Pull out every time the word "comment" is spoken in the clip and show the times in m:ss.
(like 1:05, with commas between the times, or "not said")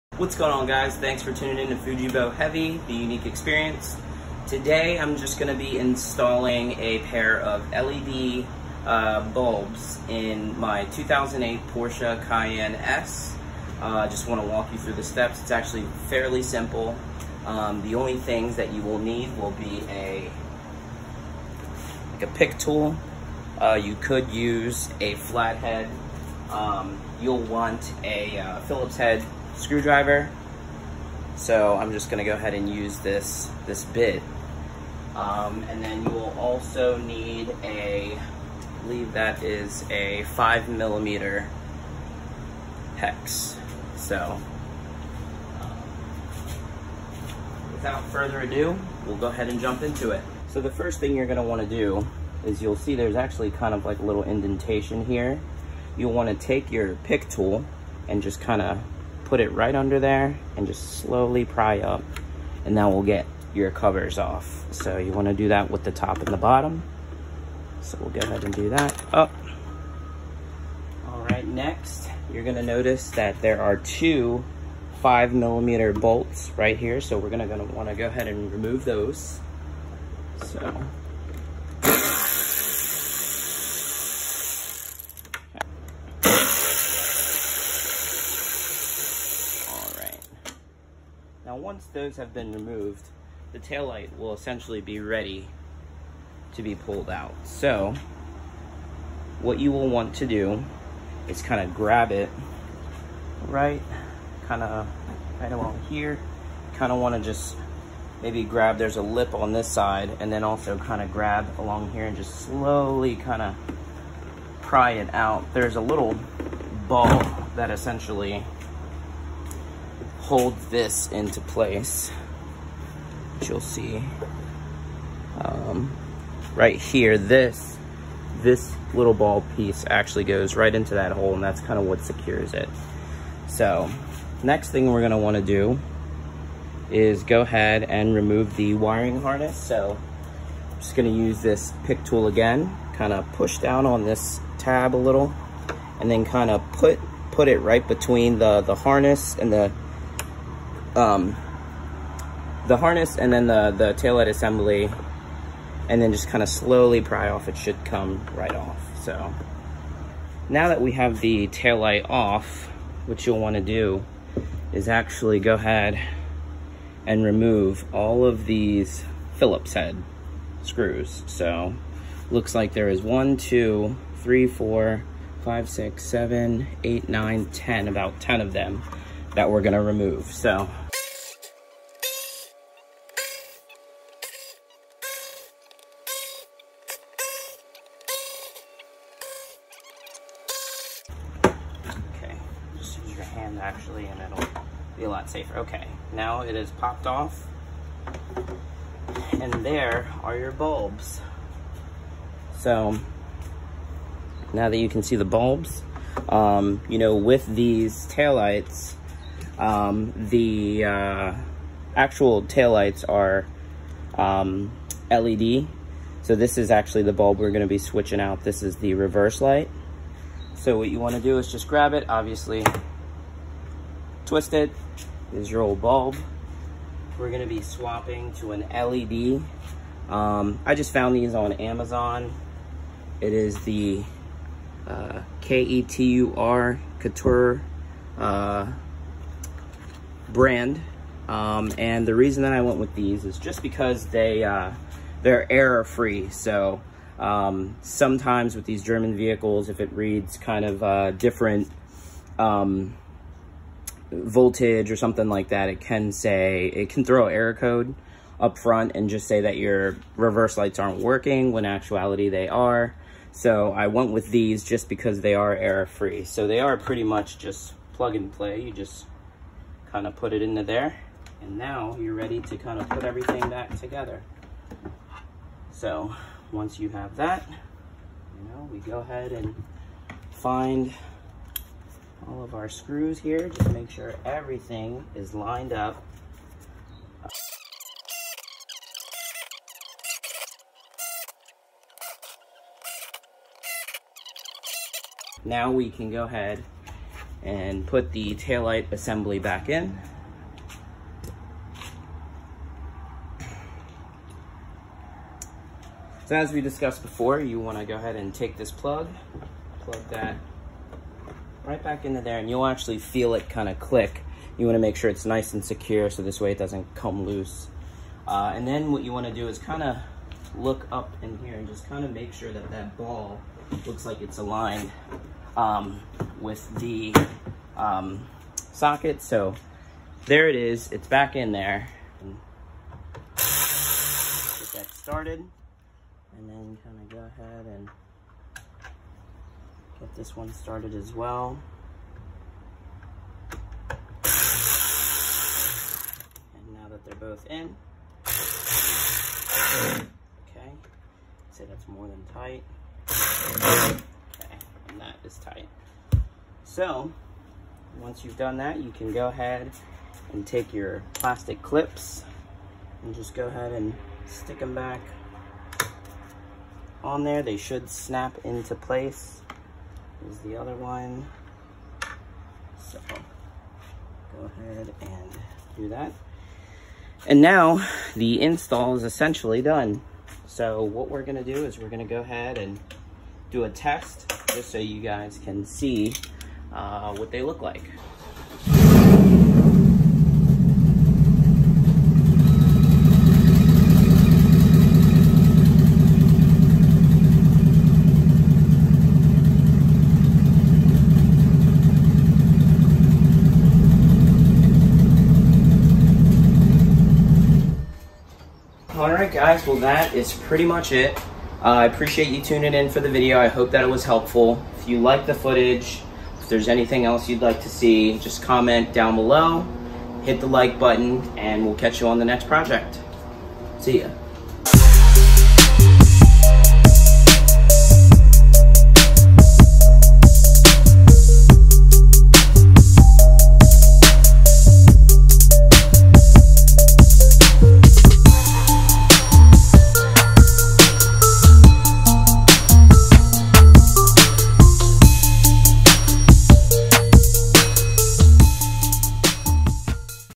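6:58.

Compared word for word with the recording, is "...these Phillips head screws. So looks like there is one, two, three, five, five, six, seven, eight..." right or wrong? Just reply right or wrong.
wrong.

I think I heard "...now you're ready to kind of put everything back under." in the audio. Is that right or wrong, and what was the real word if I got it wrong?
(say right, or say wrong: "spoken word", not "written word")
wrong: "together", not "under".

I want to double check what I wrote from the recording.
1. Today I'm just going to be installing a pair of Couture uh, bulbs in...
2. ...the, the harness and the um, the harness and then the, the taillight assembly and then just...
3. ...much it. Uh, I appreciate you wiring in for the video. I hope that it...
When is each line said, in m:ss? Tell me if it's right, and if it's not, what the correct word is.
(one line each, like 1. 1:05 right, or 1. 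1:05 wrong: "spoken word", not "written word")
1. 0:04 wrong: "LED", not "Couture"
2. 2:28 right
3. 6:50 wrong: "tuning", not "wiring".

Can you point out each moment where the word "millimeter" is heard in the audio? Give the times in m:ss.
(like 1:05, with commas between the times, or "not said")
0:40, 1:15.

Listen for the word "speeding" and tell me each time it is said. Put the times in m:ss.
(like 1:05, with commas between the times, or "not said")
not said.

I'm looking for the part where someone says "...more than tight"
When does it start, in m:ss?
5:51.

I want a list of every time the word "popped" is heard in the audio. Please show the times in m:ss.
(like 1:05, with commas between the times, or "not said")
3:16.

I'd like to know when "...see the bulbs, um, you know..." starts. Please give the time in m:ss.
3:25.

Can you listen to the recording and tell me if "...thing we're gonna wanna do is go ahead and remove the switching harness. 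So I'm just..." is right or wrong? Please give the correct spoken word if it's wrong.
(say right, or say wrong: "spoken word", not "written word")
wrong: "wiring", not "switching".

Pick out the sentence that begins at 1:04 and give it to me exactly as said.
So you wanna do that with the top and the bottom.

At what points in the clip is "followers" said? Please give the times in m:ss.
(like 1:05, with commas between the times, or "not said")
not said.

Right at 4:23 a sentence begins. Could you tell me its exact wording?
So I went with these just because they are error free.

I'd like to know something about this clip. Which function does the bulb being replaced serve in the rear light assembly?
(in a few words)
Reverse light.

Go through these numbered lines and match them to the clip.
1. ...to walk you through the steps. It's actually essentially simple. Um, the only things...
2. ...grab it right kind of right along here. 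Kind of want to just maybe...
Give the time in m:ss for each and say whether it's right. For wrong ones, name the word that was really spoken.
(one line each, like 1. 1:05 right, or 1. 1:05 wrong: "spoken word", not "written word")
1. 0:14 wrong: "fairly", not "essentially"
2. 1:41 right.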